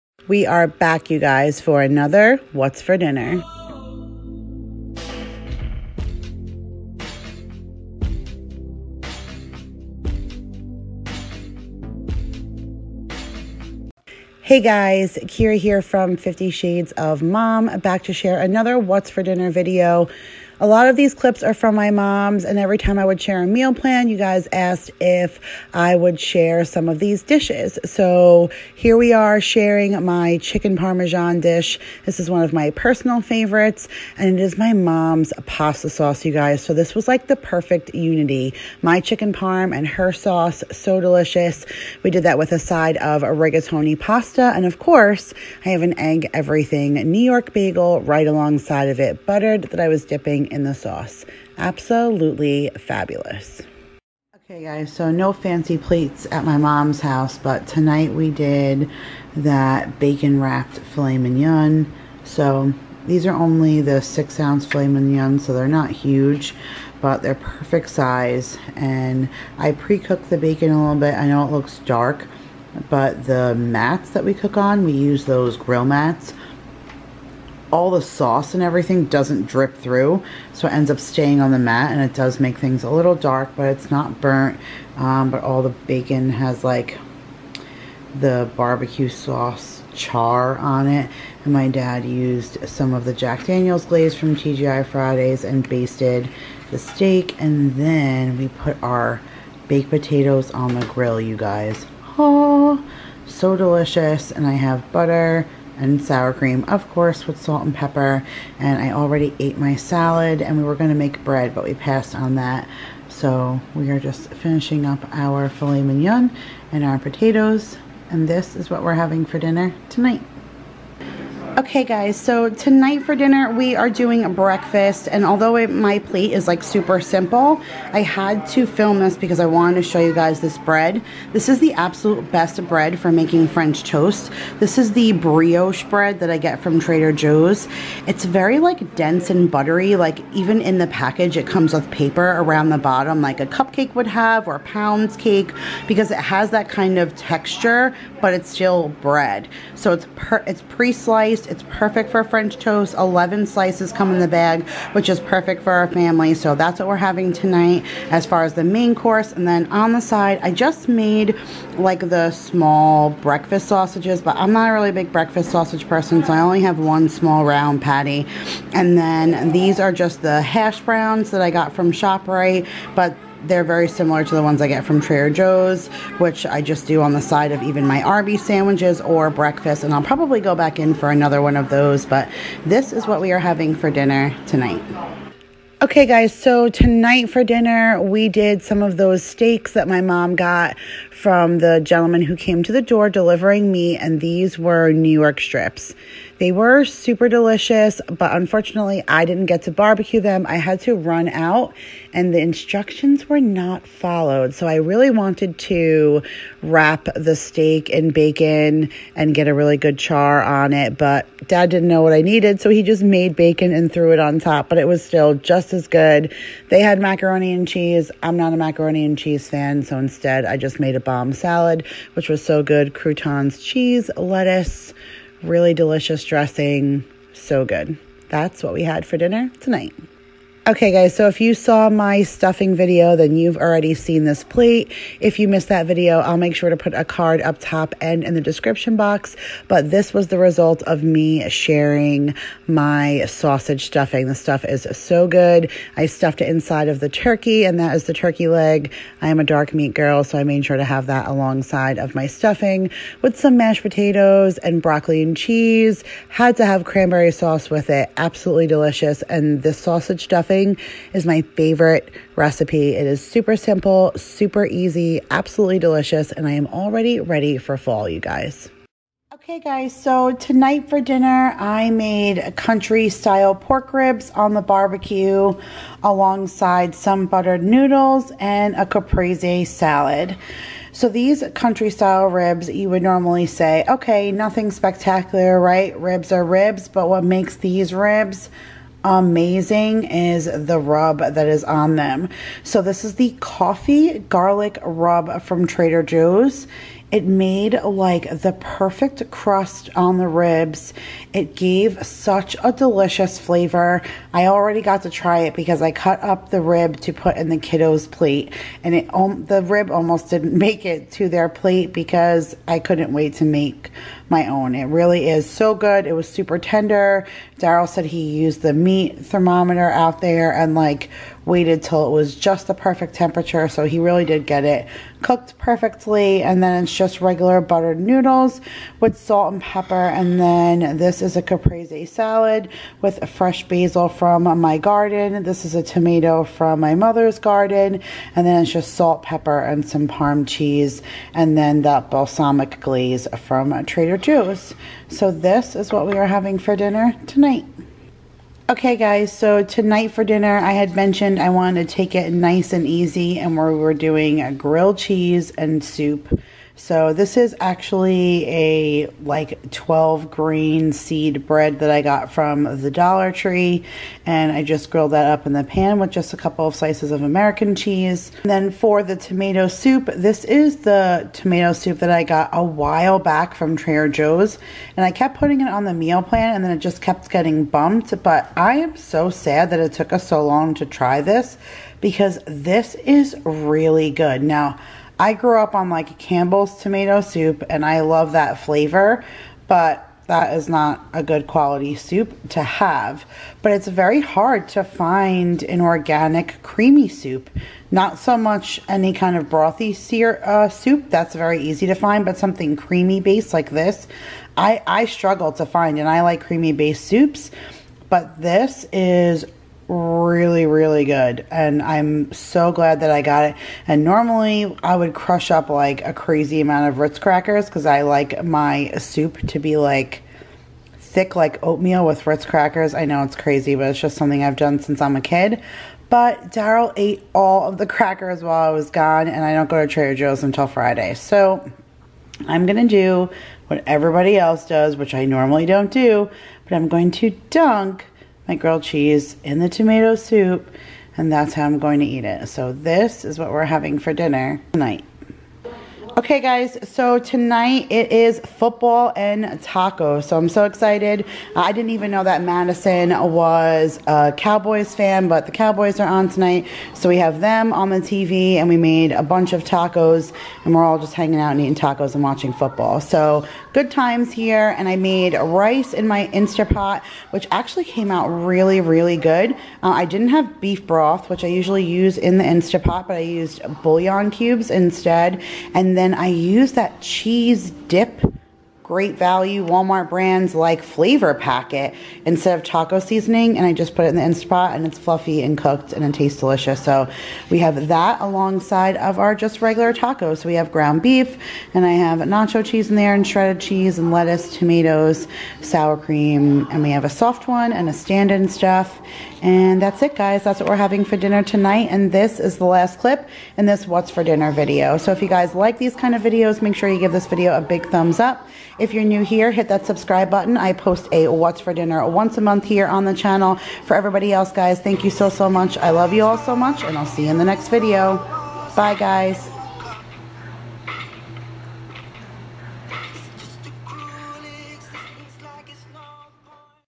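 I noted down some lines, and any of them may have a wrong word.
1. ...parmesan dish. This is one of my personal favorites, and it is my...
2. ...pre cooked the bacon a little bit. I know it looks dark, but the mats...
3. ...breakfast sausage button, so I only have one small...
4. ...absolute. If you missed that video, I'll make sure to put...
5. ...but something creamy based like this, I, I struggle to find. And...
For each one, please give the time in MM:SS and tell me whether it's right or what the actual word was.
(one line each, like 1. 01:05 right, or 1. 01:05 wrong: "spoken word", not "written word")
1. 00:30 right
2. 01:09 right
3. 02:45 wrong: "person", not "button"
4. 03:54 wrong: "plate", not "absolute"
5. 06:42 right.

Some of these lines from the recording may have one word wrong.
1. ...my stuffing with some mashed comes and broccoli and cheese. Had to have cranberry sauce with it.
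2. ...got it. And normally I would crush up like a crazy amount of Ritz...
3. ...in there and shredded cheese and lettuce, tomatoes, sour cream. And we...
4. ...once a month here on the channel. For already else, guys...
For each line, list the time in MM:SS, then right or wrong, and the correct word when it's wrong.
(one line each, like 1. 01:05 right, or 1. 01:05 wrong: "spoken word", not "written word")
1. 04:12 wrong: "potatoes", not "comes"
2. 06:53 right
3. 08:12 right
4. 08:32 wrong: "everybody", not "already".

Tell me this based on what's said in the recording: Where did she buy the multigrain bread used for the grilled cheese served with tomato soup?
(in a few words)
Dollar Tree.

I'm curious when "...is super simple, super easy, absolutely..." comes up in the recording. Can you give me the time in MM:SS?
04:23.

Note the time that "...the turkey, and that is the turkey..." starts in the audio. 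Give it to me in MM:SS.
04:06.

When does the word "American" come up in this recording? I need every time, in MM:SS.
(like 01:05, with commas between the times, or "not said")
06:07.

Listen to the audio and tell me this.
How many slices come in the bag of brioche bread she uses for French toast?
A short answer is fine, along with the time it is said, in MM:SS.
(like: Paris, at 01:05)
11, at 02:32.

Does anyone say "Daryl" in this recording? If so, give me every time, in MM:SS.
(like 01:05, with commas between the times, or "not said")
05:17, 07:06.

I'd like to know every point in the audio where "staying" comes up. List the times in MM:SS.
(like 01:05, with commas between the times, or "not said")
01:20.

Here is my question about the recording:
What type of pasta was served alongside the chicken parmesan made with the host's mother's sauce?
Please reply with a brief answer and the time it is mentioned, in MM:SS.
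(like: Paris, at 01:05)
rigatoni, at 00:43.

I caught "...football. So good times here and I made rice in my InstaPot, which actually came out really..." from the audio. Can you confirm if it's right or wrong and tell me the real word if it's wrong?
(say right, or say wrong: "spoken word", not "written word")
right.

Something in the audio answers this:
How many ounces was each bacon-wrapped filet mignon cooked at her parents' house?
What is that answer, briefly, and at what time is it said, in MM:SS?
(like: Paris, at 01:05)
6, at 01:04.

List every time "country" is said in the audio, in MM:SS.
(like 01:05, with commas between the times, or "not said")
04:32, 04:41.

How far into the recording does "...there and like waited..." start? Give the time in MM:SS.
05:20.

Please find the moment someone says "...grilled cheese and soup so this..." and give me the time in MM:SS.
05:54.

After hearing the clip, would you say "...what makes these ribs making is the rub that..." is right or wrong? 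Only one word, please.
wrong.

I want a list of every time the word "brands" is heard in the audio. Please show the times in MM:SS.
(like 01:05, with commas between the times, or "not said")
08:00.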